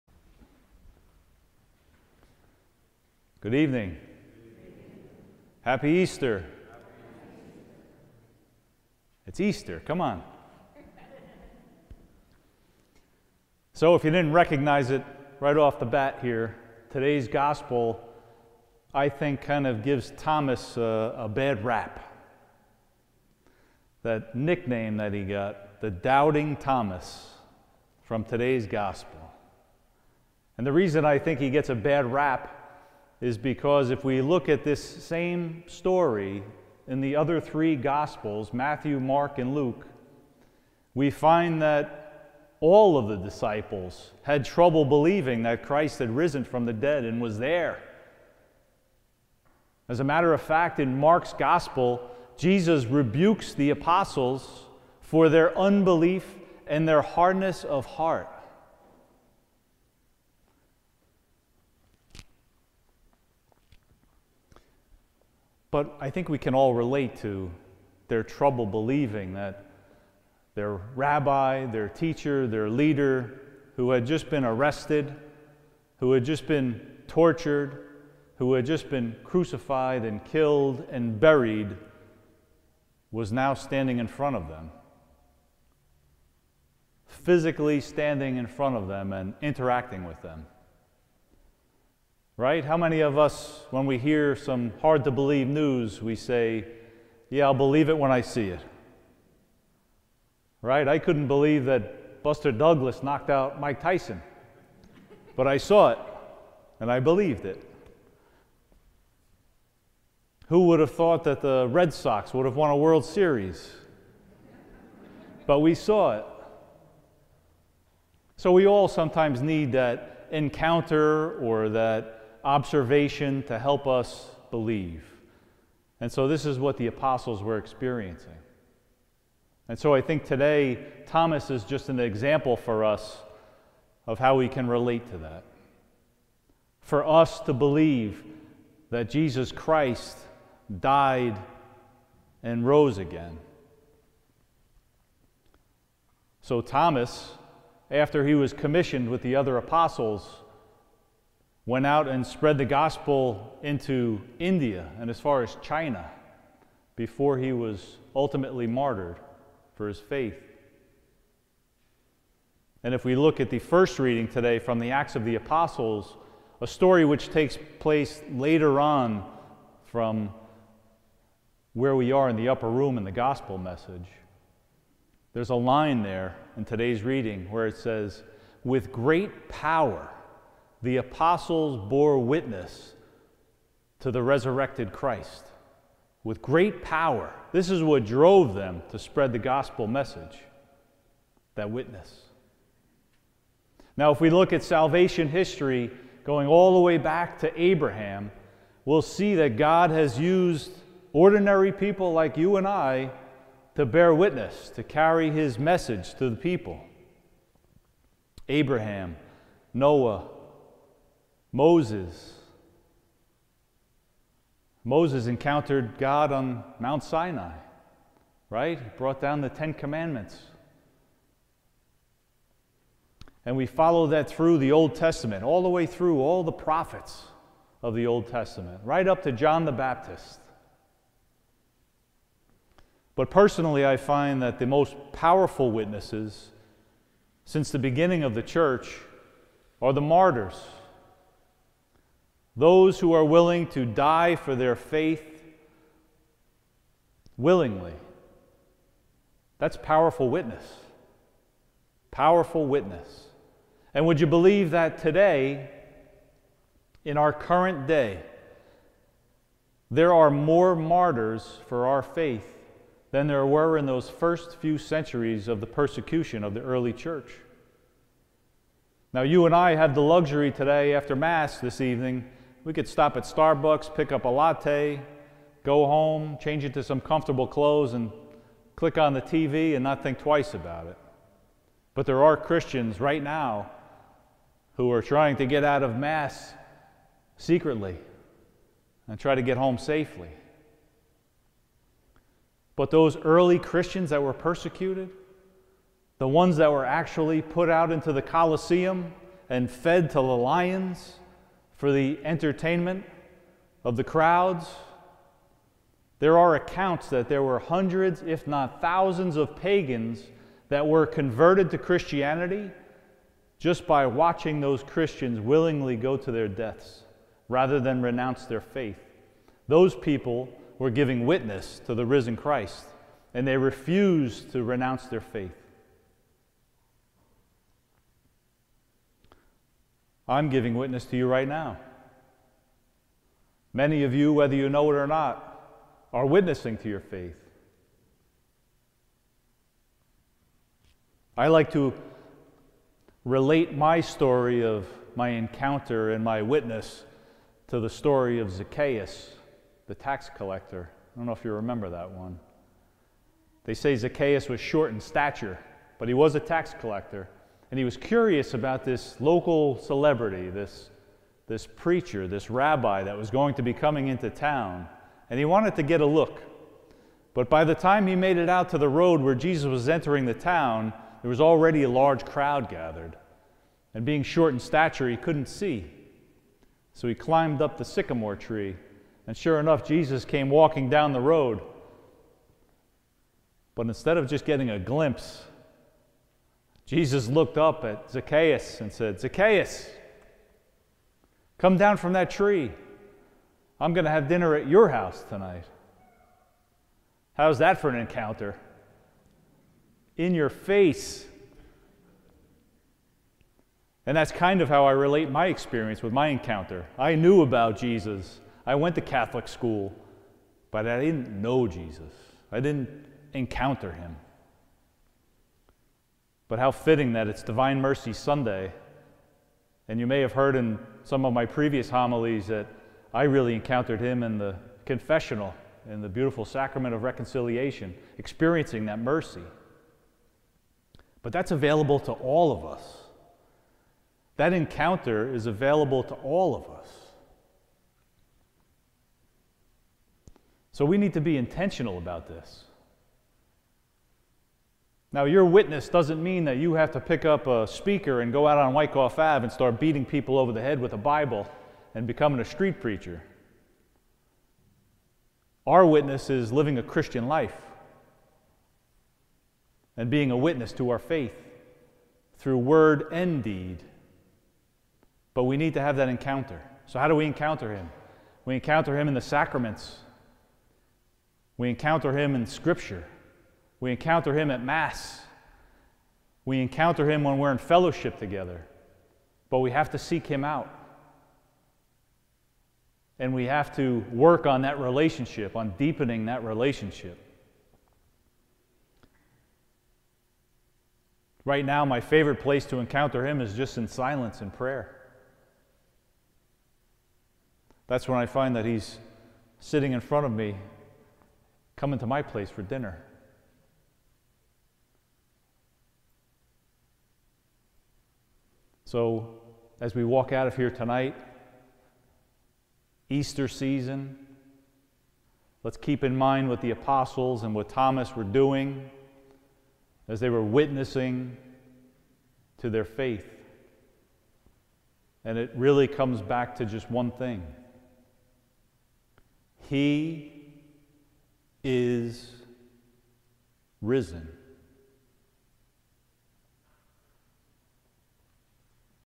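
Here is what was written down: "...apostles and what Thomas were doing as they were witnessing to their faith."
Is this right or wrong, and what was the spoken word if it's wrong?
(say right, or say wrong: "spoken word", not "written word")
right.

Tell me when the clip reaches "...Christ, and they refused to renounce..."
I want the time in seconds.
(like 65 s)
322 s.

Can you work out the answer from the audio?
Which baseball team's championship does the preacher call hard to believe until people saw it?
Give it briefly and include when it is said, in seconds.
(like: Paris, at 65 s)
Red Sox, at 111 s.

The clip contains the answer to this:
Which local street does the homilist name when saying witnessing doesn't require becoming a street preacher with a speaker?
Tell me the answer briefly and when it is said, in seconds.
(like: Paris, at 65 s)
Wyckoff Ave, at 448 s.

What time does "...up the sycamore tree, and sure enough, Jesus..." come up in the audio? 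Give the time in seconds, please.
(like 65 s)
377 s.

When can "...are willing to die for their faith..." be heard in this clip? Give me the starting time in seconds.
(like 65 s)
243 s.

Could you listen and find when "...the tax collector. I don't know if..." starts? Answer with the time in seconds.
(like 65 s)
349 s.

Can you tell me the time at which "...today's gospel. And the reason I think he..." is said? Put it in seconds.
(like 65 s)
28 s.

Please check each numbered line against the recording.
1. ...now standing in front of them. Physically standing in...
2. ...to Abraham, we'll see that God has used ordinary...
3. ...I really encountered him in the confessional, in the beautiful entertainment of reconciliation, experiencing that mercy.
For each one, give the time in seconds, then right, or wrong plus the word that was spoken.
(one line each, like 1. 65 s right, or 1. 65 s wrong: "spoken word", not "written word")
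1. 83 s right
2. 197 s right
3. 423 s wrong: "sacrament", not "entertainment".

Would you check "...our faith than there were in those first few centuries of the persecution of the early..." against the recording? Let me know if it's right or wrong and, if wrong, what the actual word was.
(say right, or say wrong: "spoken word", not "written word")
right.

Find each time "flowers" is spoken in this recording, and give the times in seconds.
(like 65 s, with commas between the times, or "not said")
not said.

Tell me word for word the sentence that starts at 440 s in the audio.
So we need to be intentional about this.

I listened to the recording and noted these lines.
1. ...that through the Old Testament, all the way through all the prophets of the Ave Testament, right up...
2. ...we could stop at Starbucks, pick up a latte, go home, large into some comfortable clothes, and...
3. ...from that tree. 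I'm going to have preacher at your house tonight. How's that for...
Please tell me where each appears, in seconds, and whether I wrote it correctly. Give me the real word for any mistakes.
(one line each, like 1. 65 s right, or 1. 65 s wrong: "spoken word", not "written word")
1. 224 s wrong: "Old", not "Ave"
2. 272 s wrong: "change", not "large"
3. 391 s wrong: "dinner", not "preacher".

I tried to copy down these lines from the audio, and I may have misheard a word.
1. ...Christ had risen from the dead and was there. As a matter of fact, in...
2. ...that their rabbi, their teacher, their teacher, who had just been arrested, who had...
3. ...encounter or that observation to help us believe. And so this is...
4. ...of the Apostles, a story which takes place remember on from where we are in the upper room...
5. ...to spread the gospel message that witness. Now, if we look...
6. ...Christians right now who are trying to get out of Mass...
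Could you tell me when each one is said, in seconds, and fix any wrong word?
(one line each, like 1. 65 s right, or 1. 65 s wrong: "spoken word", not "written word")
1. 45 s right
2. 69 s wrong: "leader", not "teacher"
3. 120 s right
4. 165 s wrong: "later", not "remember"
5. 188 s right
6. 282 s right.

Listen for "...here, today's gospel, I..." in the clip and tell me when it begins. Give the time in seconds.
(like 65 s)
16 s.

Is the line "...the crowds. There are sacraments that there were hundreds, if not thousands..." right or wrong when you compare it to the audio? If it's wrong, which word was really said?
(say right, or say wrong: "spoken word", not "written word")
wrong: "accounts", not "sacraments".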